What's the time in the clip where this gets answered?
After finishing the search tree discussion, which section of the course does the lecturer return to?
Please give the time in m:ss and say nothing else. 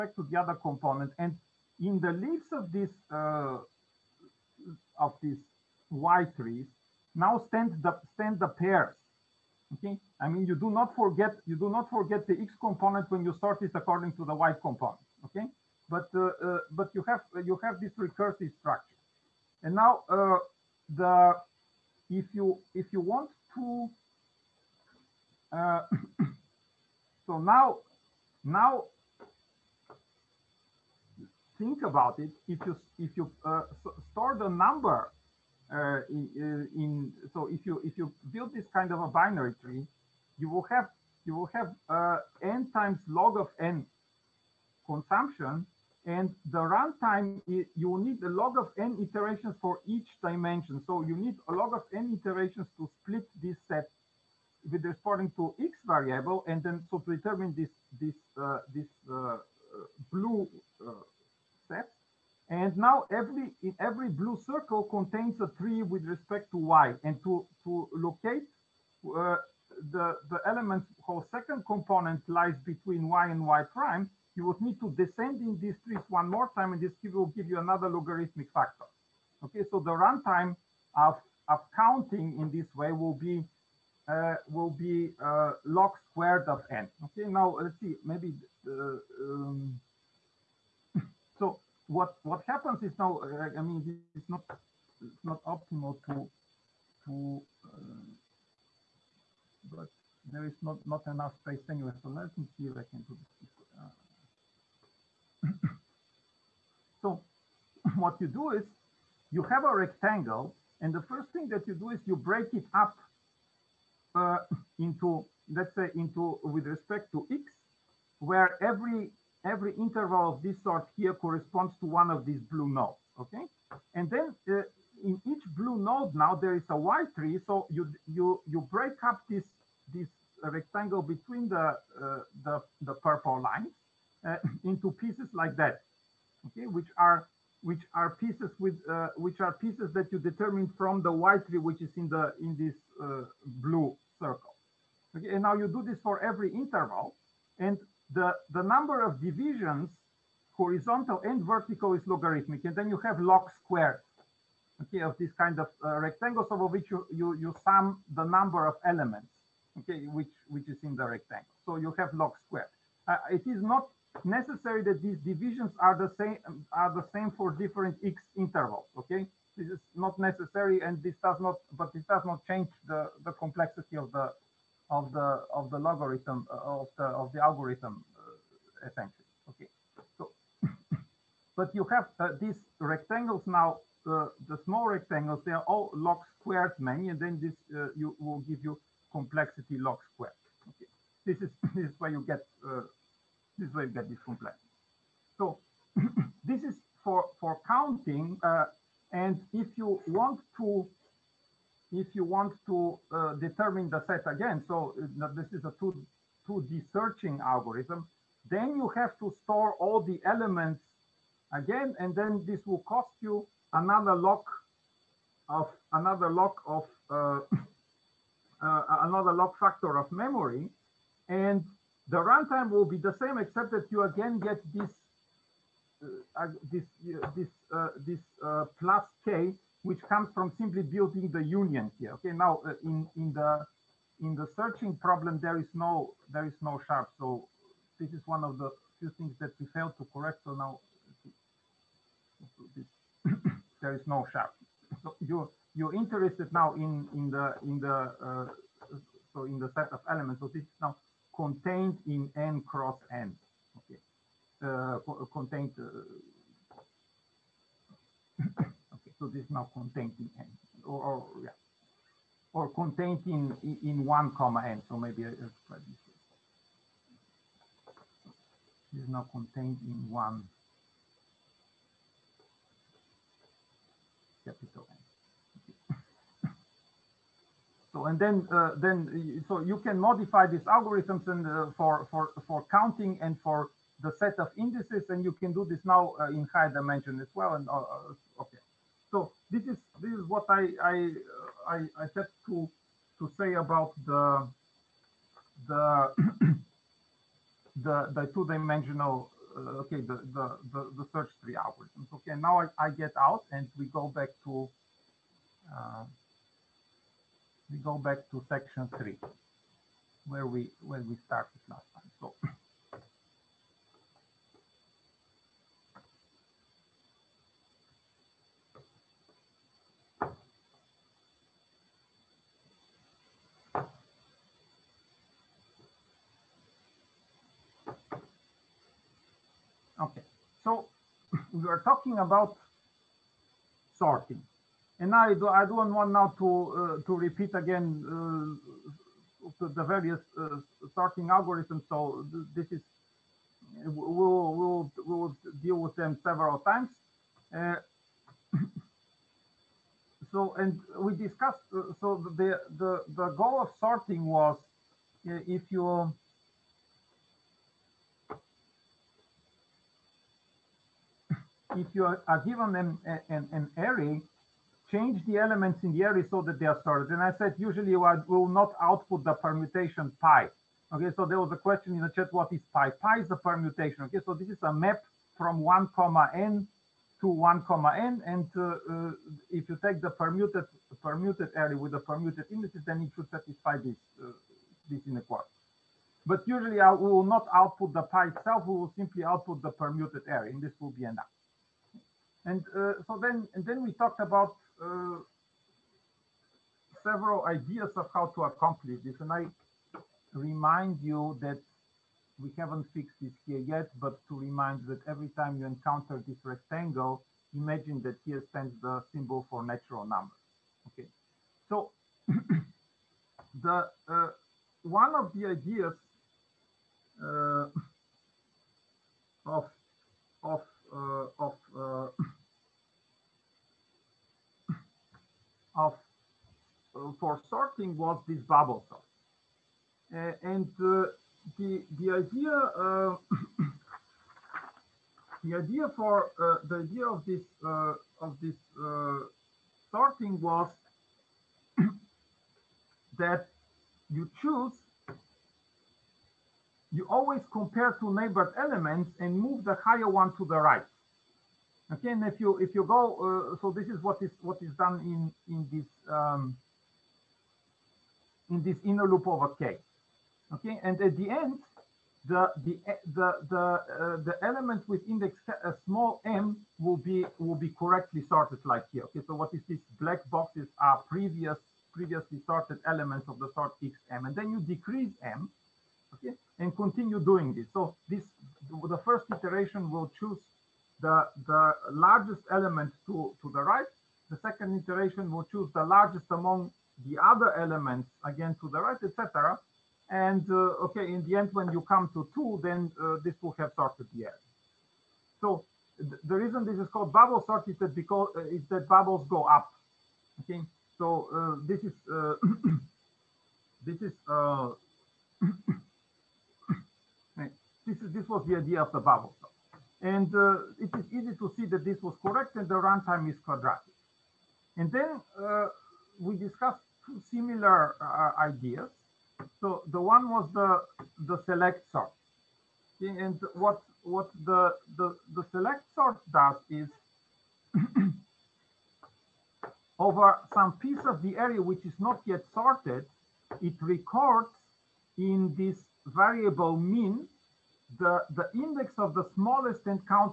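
5:08.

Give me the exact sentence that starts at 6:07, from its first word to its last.
And I said, usually I will not output the permutation pi.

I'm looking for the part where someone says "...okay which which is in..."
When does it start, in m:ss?
2:39.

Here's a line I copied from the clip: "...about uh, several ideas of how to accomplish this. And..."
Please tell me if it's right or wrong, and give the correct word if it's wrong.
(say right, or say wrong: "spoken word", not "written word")
right.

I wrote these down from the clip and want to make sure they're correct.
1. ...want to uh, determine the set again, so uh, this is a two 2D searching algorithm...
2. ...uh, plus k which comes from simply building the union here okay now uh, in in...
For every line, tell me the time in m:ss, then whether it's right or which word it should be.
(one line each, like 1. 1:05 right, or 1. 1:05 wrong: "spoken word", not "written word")
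1. 3:22 right
2. 3:48 right.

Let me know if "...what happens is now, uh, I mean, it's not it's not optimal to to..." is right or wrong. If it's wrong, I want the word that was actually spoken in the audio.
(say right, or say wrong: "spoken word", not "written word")
right.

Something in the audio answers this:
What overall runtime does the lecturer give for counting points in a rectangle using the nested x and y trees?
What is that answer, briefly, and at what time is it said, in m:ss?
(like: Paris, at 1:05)
log squared of n, at 1:25.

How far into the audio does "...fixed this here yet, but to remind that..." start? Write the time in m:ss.
6:42.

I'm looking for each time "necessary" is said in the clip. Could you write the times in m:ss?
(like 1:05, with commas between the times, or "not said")
2:44, 2:50.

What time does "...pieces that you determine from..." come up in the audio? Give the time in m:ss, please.
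2:19.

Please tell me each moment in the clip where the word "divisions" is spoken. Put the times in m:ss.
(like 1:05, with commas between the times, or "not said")
2:29, 2:45.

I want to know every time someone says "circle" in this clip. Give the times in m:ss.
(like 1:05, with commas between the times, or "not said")
1:04, 2:24.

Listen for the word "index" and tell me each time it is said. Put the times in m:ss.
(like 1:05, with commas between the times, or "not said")
7:45, 8:58.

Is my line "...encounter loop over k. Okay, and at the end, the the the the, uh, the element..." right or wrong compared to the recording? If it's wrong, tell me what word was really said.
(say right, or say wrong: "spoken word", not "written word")
wrong: "inner", not "encounter".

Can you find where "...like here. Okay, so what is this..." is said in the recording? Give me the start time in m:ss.
7:48.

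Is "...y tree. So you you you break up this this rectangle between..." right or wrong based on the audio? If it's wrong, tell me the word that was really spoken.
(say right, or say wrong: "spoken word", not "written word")
right.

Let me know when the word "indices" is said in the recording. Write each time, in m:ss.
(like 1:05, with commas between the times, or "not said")
4:44, 6:22.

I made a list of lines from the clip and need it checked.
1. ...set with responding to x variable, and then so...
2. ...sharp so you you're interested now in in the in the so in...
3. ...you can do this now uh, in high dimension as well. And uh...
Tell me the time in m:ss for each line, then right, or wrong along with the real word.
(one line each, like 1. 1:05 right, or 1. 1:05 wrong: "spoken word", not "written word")
1. 0:53 right
2. 4:04 right
3. 4:45 right.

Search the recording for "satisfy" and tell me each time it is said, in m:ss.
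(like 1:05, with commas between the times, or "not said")
6:23.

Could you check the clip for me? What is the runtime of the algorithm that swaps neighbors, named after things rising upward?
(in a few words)
quadratic.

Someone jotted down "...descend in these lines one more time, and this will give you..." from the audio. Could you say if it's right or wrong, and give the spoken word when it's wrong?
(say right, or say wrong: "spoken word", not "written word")
wrong: "trees", not "lines".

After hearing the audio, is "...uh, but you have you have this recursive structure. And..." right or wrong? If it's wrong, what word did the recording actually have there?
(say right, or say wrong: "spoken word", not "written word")
right.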